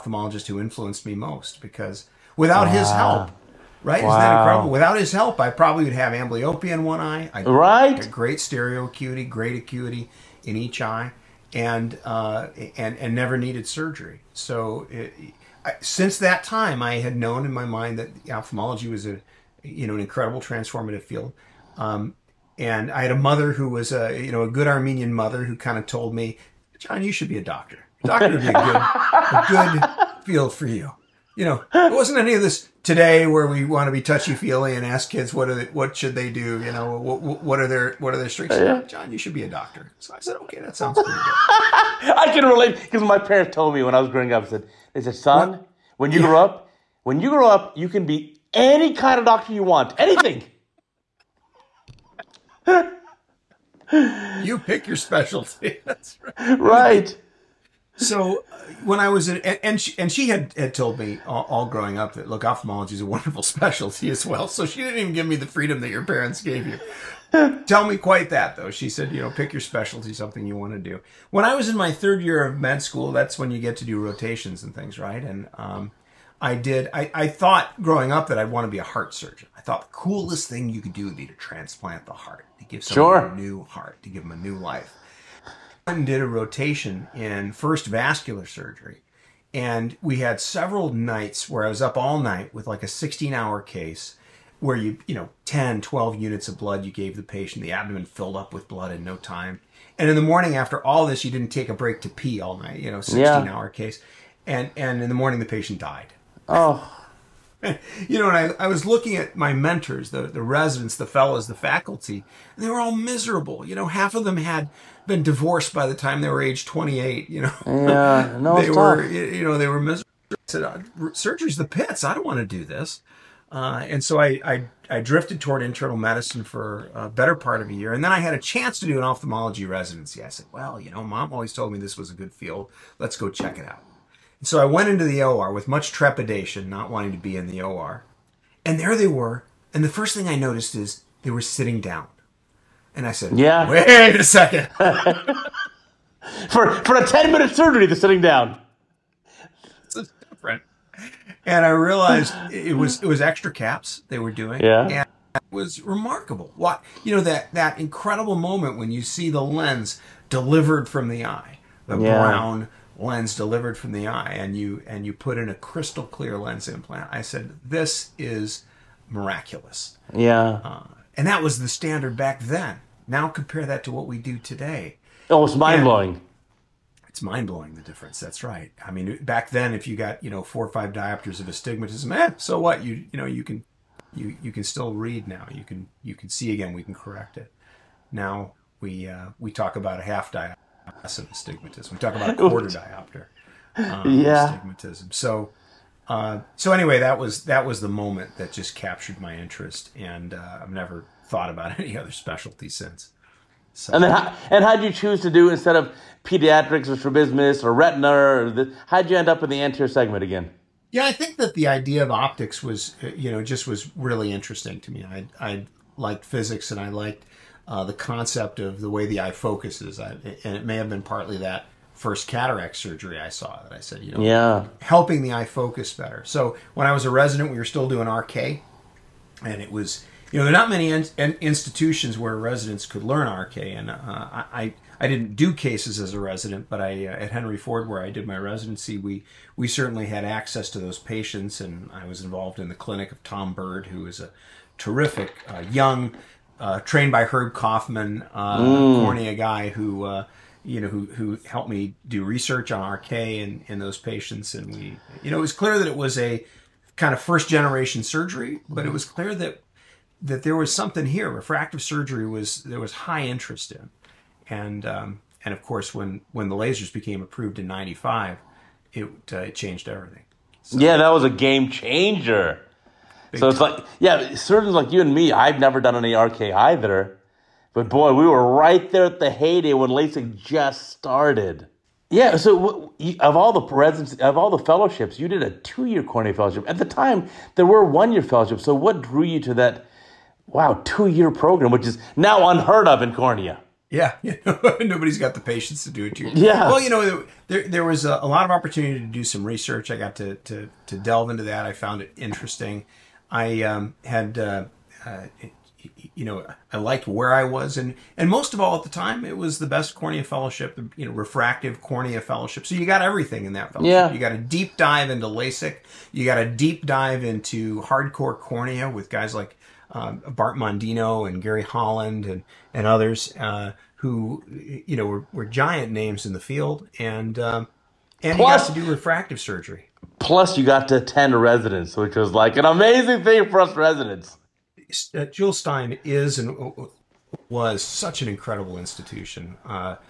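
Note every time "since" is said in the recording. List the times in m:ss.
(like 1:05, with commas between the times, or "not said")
0:15, 3:22.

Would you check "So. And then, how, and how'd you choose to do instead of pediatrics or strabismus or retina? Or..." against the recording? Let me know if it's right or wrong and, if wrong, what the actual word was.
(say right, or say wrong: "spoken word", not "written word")
right.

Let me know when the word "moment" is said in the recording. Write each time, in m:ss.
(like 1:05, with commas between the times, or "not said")
2:38, 3:17.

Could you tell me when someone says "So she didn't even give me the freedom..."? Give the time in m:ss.
1:04.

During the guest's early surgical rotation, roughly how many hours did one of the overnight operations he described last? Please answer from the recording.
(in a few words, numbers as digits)
16.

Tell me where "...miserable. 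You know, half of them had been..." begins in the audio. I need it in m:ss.
1:52.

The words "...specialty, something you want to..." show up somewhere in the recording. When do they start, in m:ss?
1:09.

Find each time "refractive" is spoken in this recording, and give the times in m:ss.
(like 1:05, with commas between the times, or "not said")
4:21, 5:11, 5:28.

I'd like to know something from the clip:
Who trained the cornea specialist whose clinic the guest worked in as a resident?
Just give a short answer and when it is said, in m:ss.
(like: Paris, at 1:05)
Herb Kaufman, at 4:07.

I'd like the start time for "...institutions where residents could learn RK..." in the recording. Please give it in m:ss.
3:51.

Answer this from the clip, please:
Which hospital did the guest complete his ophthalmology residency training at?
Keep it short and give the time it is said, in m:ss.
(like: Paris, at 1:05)
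Henry Ford, at 3:57.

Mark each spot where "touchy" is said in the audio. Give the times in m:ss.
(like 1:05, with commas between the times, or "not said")
0:34.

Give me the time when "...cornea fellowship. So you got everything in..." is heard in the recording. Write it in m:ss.
5:11.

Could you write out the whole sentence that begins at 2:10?
I said, "Well, you know, mom always told me this was a good field.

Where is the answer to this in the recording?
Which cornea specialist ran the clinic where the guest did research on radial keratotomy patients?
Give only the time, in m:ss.
4:03.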